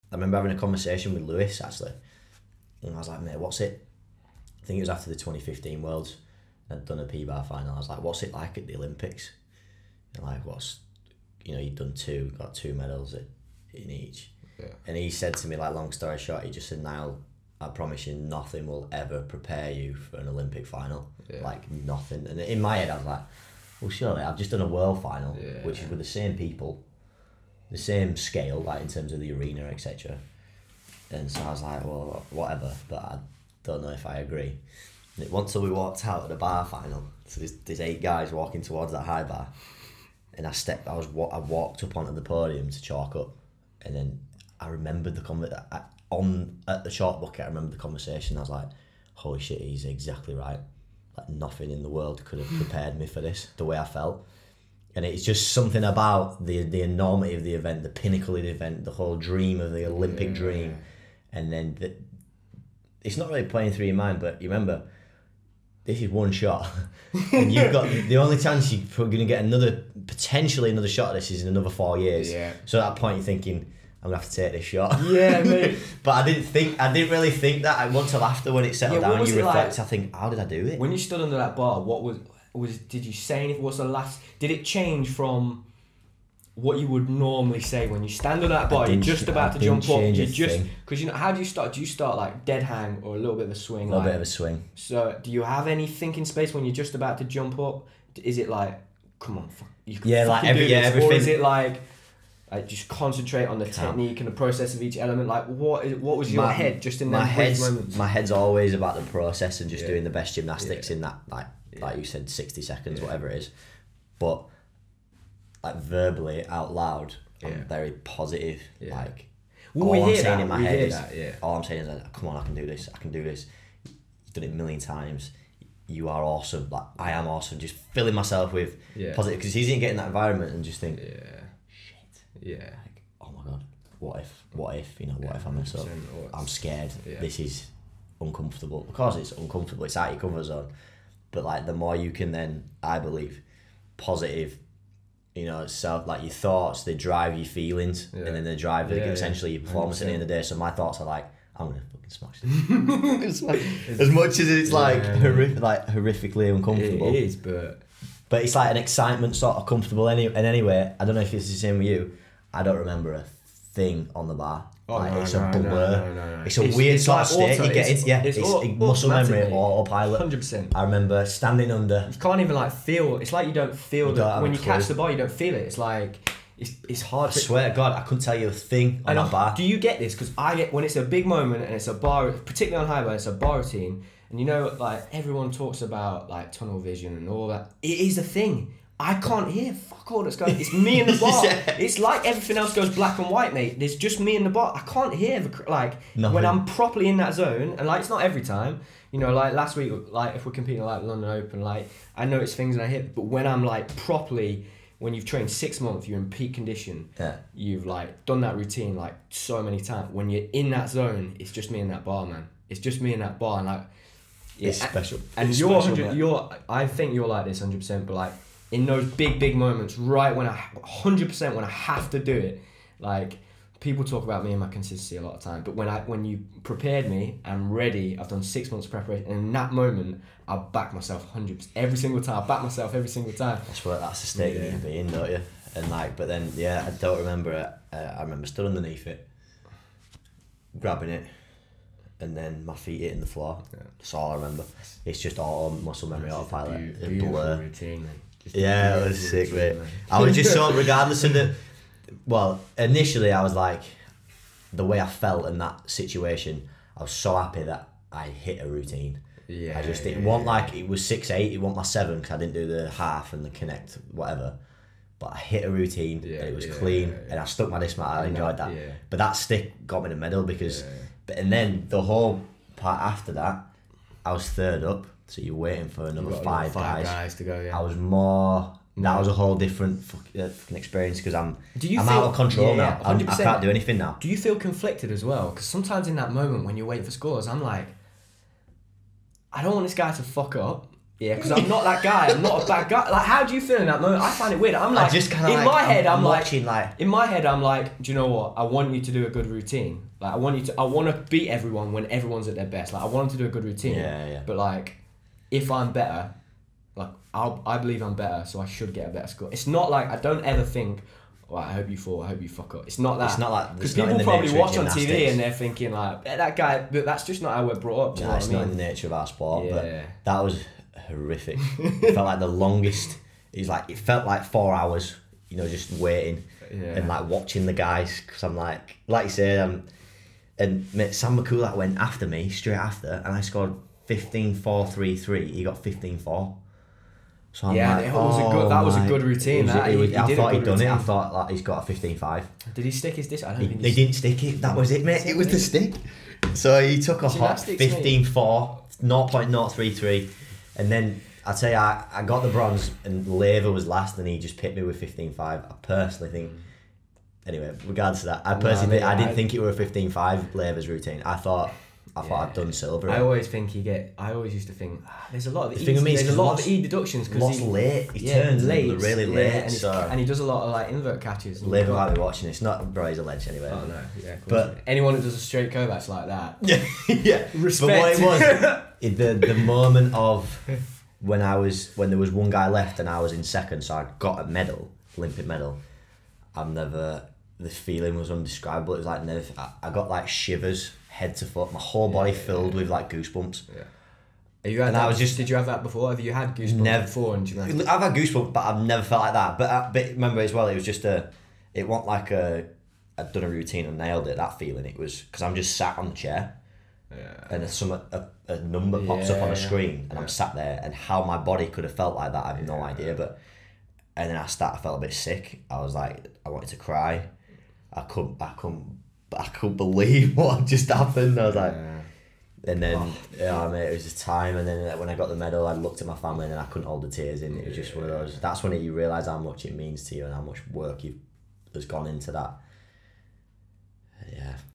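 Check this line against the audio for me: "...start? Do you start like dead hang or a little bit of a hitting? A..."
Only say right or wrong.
wrong.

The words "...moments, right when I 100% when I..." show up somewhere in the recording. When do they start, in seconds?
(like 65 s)
219 s.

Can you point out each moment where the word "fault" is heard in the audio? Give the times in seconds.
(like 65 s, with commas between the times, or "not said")
not said.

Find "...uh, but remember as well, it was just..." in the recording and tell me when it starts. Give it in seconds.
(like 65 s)
399 s.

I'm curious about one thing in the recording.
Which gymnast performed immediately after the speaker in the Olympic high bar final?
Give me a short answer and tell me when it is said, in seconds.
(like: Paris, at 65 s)
Sam Mikulak, at 331 s.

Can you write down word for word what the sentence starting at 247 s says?
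Routine, yeah, it was sick, mate.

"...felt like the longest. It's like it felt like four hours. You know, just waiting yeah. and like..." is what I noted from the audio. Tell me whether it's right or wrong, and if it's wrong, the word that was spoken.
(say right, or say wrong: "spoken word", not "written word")
right.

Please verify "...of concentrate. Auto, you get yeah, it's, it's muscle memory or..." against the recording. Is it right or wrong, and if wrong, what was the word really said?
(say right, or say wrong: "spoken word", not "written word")
wrong: "state", not "concentrate".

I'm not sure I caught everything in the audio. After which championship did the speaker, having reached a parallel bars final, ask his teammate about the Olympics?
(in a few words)
2015 Worlds.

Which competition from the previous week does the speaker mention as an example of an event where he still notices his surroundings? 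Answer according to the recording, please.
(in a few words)
London Open.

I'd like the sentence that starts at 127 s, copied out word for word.
Just filling myself with positive because it's easy to get in that environment and just think, yeah, shit, yeah.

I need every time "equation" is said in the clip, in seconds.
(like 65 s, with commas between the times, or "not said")
not said.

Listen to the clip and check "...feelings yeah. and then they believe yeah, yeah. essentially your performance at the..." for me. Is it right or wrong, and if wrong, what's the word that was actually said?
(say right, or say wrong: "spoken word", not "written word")
wrong: "drive", not "believe".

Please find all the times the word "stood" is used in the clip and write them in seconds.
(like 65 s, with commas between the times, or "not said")
80 s, 238 s.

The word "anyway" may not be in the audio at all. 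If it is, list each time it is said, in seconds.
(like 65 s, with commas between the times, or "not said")
160 s, 357 s, 373 s.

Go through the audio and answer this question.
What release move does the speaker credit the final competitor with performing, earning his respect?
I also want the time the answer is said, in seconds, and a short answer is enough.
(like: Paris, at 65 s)
straight Kovacs, at 375 s.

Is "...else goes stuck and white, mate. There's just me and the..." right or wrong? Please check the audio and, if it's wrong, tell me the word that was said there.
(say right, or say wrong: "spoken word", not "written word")
wrong: "black", not "stuck".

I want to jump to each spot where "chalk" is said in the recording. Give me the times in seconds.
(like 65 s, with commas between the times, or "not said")
42 s, 46 s.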